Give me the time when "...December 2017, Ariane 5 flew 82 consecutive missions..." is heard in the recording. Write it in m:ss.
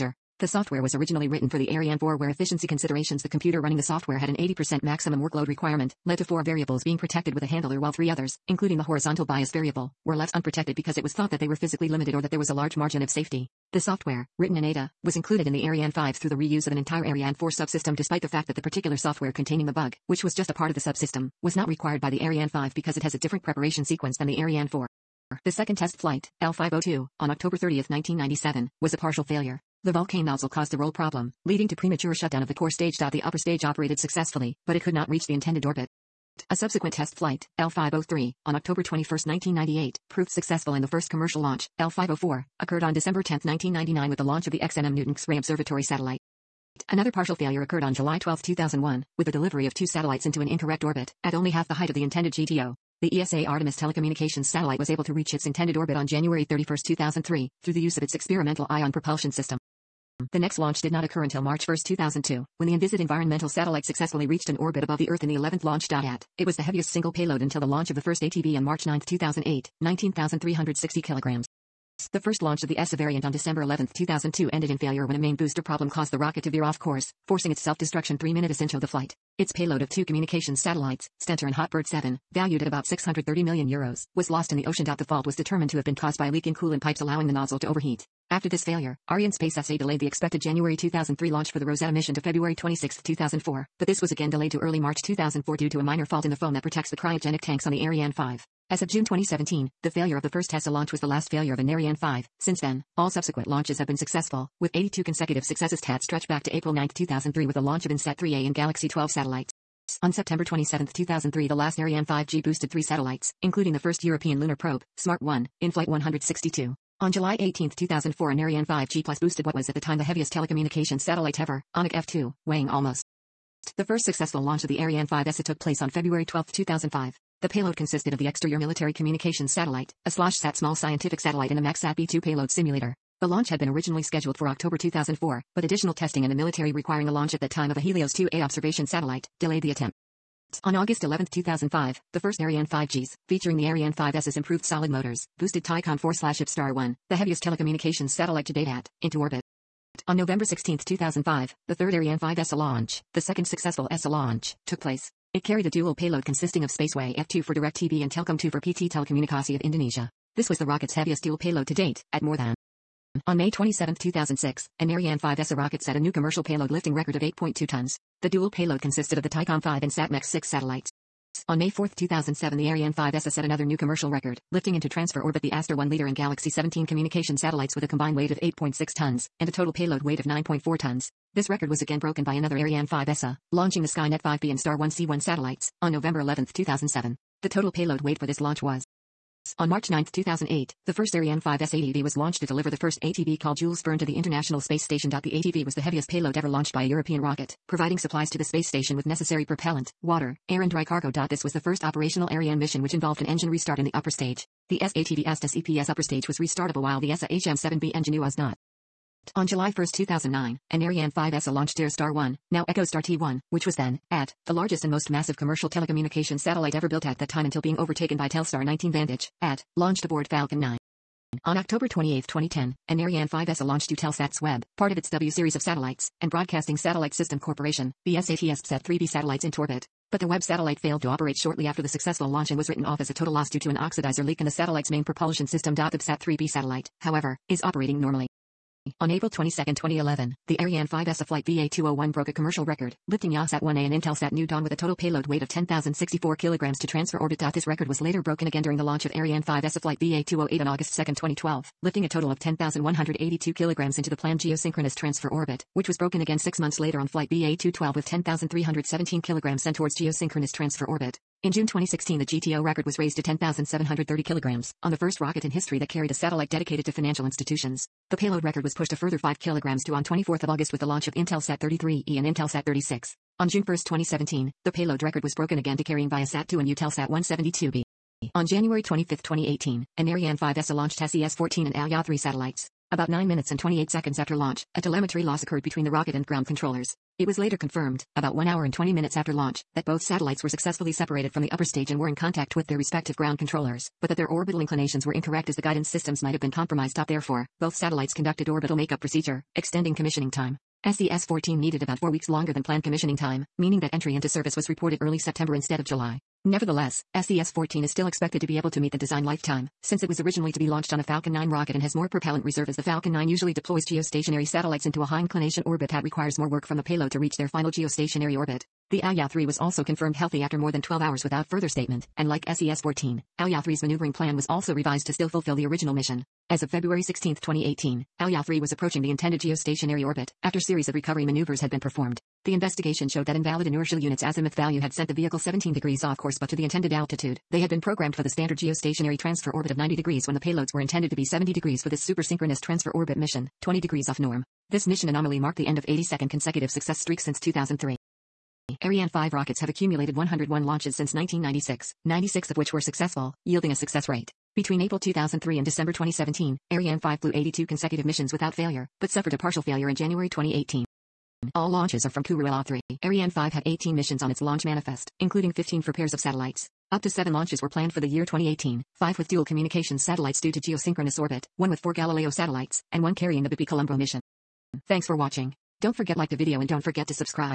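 5:55.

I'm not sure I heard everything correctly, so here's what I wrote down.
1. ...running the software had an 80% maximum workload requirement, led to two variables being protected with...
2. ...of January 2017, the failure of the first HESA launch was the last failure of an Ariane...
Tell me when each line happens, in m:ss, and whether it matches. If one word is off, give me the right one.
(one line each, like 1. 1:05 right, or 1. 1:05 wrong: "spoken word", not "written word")
1. 0:03 wrong: "four", not "two"
2. 1:38 wrong: "June", not "January".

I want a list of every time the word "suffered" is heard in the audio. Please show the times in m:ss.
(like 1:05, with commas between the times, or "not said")
5:59.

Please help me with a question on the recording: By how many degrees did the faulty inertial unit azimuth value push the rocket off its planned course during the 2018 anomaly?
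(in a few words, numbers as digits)
17 degrees.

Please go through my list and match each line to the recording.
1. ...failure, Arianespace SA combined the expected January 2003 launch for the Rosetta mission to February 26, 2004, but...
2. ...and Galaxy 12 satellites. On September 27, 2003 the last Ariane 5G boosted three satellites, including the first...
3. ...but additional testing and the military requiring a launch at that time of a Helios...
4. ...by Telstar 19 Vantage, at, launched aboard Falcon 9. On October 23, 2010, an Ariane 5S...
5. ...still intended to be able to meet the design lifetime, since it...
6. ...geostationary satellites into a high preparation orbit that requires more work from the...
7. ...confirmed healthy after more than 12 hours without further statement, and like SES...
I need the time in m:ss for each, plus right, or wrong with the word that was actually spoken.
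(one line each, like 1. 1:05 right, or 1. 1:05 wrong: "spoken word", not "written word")
1. 1:28 wrong: "delayed", not "combined"
2. 1:48 right
3. 2:15 right
4. 3:38 wrong: "28", not "23"
5. 5:07 wrong: "expected", not "intended"
6. 5:13 wrong: "inclination", not "preparation"
7. 5:19 right.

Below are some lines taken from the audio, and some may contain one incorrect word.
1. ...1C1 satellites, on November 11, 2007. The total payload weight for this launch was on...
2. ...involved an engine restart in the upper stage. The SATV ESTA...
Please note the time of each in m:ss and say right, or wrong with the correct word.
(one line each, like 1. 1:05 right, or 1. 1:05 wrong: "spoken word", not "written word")
1. 3:04 right
2. 3:22 right.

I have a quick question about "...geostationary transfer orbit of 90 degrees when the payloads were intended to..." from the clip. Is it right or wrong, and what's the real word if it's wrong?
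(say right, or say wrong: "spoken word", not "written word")
right.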